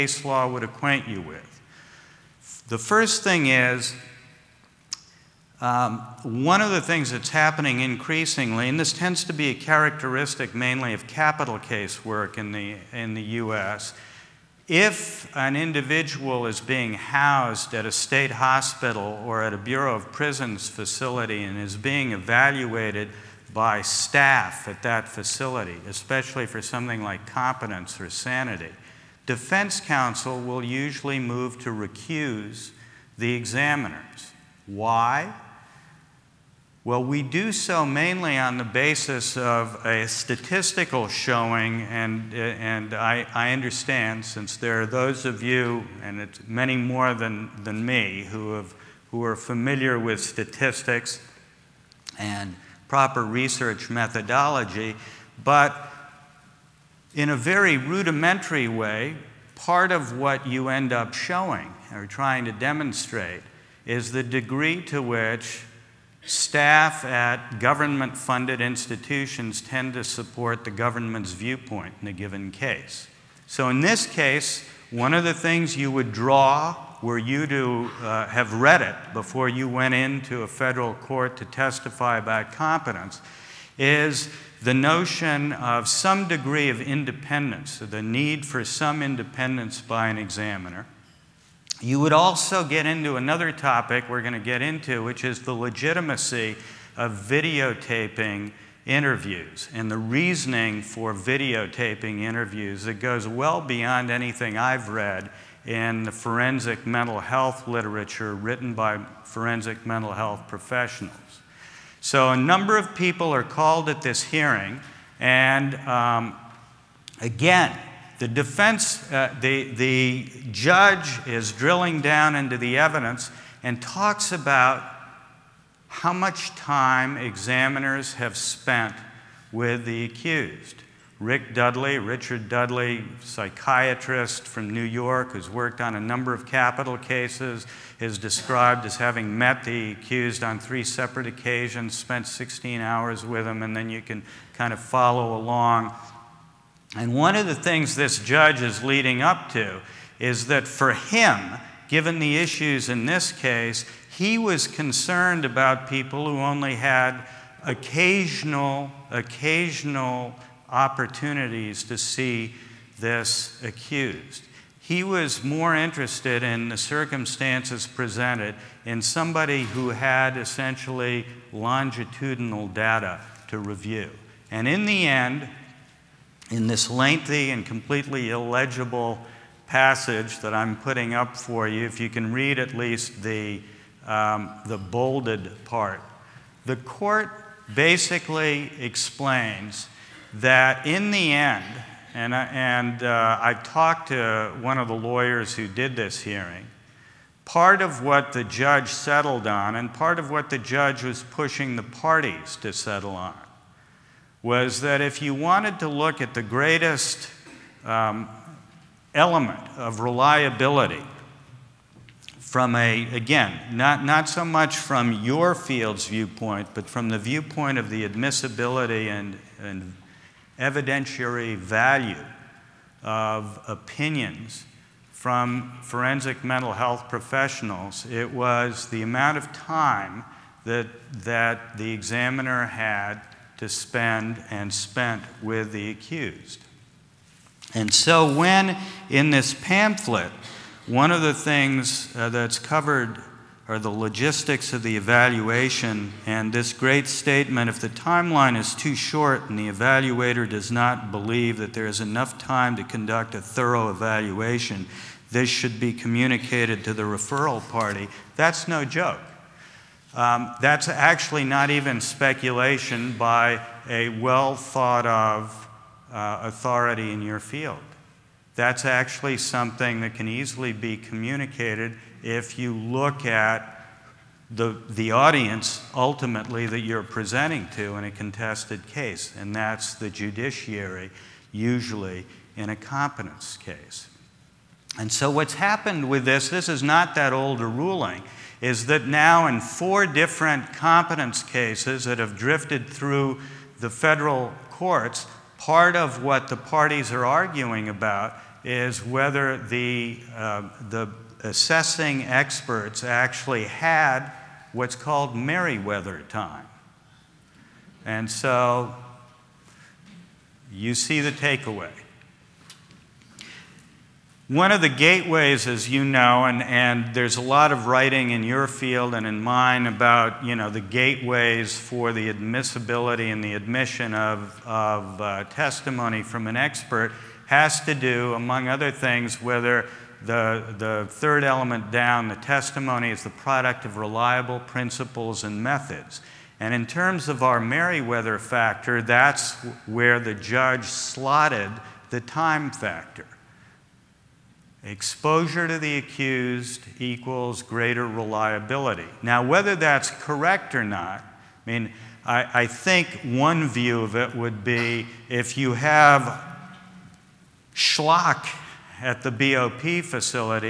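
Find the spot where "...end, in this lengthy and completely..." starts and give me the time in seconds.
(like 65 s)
175 s.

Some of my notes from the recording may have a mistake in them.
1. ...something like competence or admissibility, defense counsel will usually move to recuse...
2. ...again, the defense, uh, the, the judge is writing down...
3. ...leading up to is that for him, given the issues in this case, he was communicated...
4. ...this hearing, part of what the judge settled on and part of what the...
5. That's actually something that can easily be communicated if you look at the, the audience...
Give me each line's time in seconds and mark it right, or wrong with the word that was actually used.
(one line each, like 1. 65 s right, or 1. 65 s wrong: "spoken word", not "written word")
1. 26 s wrong: "sanity", not "admissibility"
2. 117 s wrong: "drilling", not "writing"
3. 148 s wrong: "concerned", not "communicated"
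4. 195 s right
5. 268 s right.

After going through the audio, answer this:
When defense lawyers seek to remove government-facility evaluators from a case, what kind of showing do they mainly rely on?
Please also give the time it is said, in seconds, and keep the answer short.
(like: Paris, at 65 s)
statistical showing, at 40 s.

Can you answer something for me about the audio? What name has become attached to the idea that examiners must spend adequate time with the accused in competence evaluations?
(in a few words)
Merriweather time.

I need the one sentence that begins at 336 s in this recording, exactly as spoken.
And in terms of our Merriweather factor, that's where the judge slotted the time factor.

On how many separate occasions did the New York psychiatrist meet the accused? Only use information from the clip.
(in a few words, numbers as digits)
3.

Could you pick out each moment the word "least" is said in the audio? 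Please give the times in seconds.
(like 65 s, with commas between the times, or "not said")
182 s.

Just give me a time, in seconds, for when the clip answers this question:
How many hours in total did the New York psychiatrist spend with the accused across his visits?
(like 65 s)
142 s.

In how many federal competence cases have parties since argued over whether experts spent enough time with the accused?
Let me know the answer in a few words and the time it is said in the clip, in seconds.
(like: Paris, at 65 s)
4, at 289 s.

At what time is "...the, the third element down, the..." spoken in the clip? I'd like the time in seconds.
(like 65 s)
330 s.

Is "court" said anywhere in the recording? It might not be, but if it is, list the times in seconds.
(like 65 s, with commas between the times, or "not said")
80 s, 186 s, 294 s.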